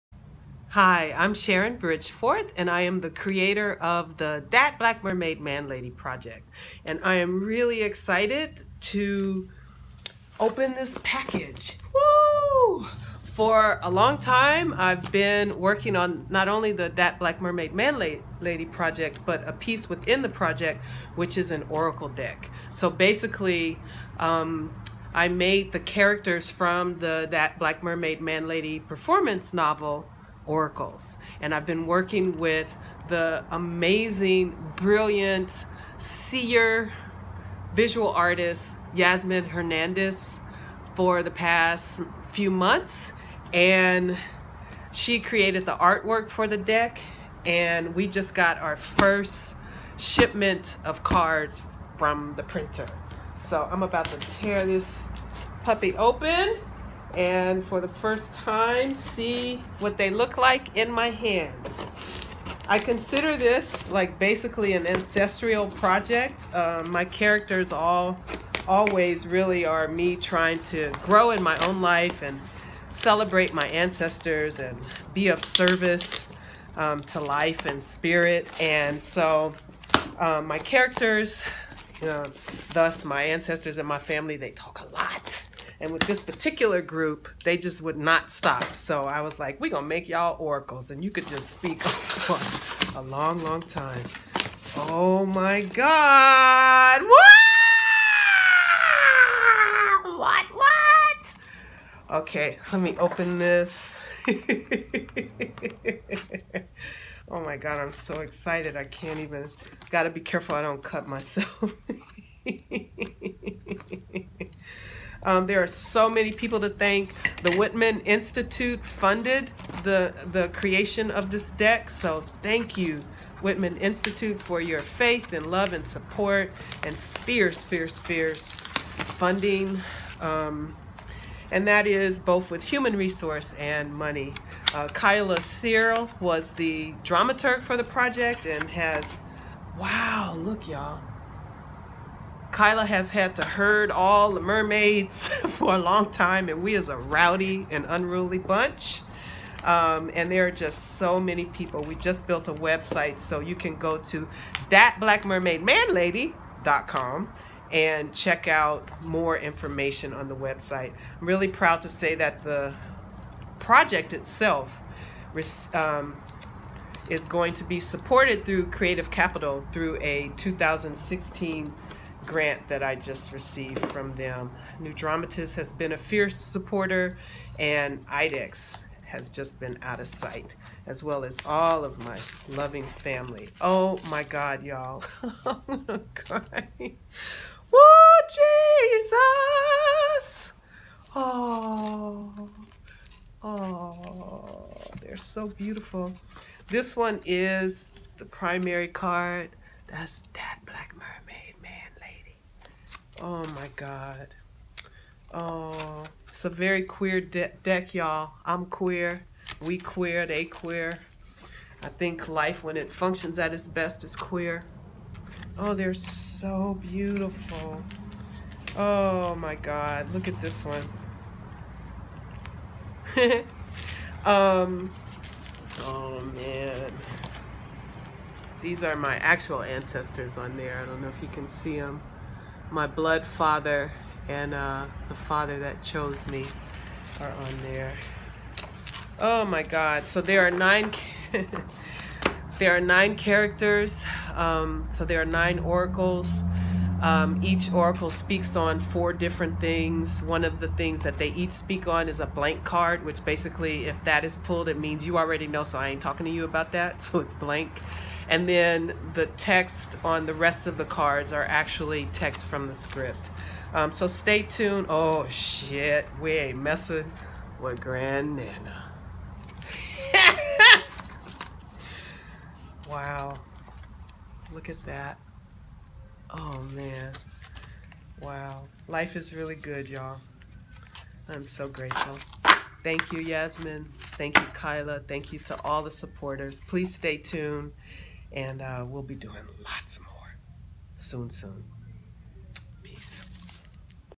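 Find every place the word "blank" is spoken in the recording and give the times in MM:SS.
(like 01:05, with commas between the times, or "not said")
04:12, 04:17.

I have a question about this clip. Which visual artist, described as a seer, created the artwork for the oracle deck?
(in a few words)
Yasmin Hernandez.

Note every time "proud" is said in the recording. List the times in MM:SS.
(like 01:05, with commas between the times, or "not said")
02:41.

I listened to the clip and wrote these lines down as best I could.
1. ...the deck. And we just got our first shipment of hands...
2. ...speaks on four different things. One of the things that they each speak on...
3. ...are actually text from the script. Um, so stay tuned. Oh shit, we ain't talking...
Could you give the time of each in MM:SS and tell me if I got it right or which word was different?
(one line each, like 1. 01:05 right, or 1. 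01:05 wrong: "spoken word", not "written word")
1. 00:46 wrong: "cards", not "hands"
2. 04:08 right
3. 04:21 wrong: "messing", not "talking".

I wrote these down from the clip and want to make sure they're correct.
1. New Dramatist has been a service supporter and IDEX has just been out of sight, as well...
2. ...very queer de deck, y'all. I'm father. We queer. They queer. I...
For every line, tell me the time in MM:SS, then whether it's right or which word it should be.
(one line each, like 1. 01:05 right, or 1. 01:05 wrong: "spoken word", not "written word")
1. 02:54 wrong: "fierce", not "service"
2. 03:26 wrong: "queer", not "father".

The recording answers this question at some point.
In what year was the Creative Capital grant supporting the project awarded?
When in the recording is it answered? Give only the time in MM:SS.
02:50.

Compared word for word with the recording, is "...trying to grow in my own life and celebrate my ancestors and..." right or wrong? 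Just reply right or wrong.
right.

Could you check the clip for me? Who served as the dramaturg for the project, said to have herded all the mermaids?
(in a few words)
Kyla Searle.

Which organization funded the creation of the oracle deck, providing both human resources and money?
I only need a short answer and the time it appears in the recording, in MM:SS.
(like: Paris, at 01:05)
The Whitman Institute, at 01:57.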